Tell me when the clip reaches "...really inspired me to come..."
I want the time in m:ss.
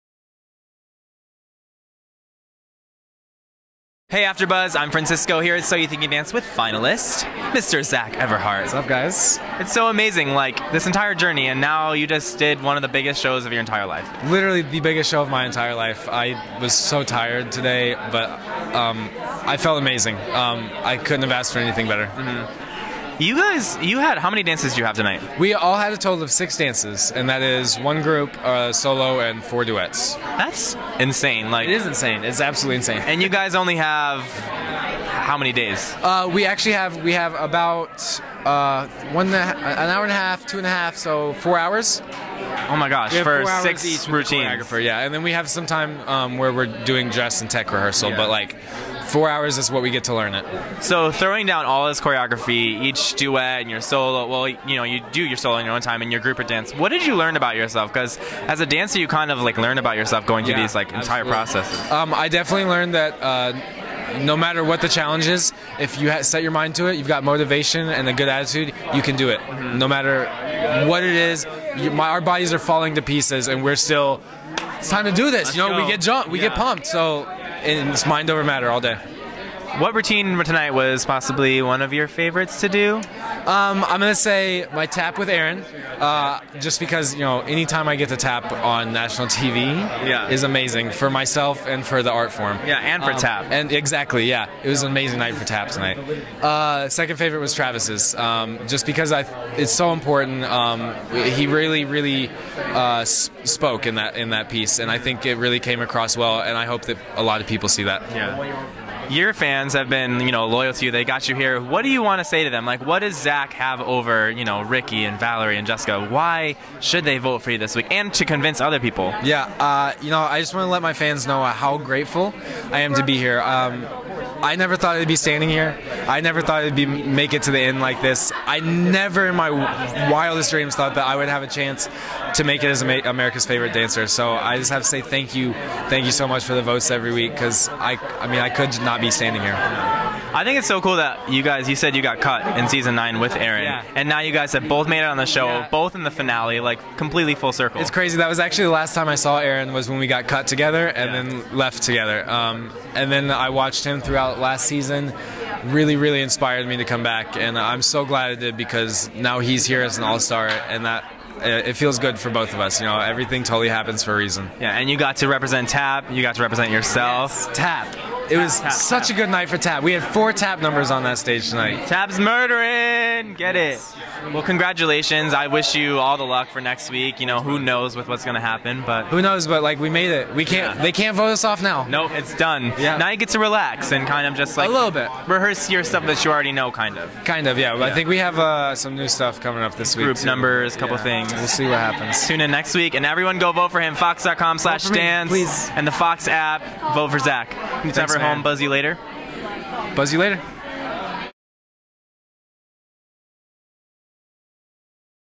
2:35.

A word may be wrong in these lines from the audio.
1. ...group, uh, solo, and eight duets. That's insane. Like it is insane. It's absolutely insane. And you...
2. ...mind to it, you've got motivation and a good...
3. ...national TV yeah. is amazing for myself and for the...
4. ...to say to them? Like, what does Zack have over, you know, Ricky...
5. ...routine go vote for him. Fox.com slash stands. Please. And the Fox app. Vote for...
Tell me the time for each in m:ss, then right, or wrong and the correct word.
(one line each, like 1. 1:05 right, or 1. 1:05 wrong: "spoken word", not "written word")
1. 0:28 wrong: "four", not "eight"
2. 1:06 right
3. 1:28 right
4. 1:52 right
5. 3:13 wrong: "everyone", not "routine".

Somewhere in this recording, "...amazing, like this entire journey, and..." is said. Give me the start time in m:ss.
0:09.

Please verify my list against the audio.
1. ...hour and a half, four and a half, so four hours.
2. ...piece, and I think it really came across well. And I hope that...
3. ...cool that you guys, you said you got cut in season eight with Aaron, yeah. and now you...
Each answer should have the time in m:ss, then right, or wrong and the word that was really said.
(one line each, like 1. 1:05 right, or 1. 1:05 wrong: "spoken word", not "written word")
1. 0:39 wrong: "two", not "four"
2. 1:44 right
3. 2:20 wrong: "nine", not "eight".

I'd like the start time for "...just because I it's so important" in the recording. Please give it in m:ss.
1:38.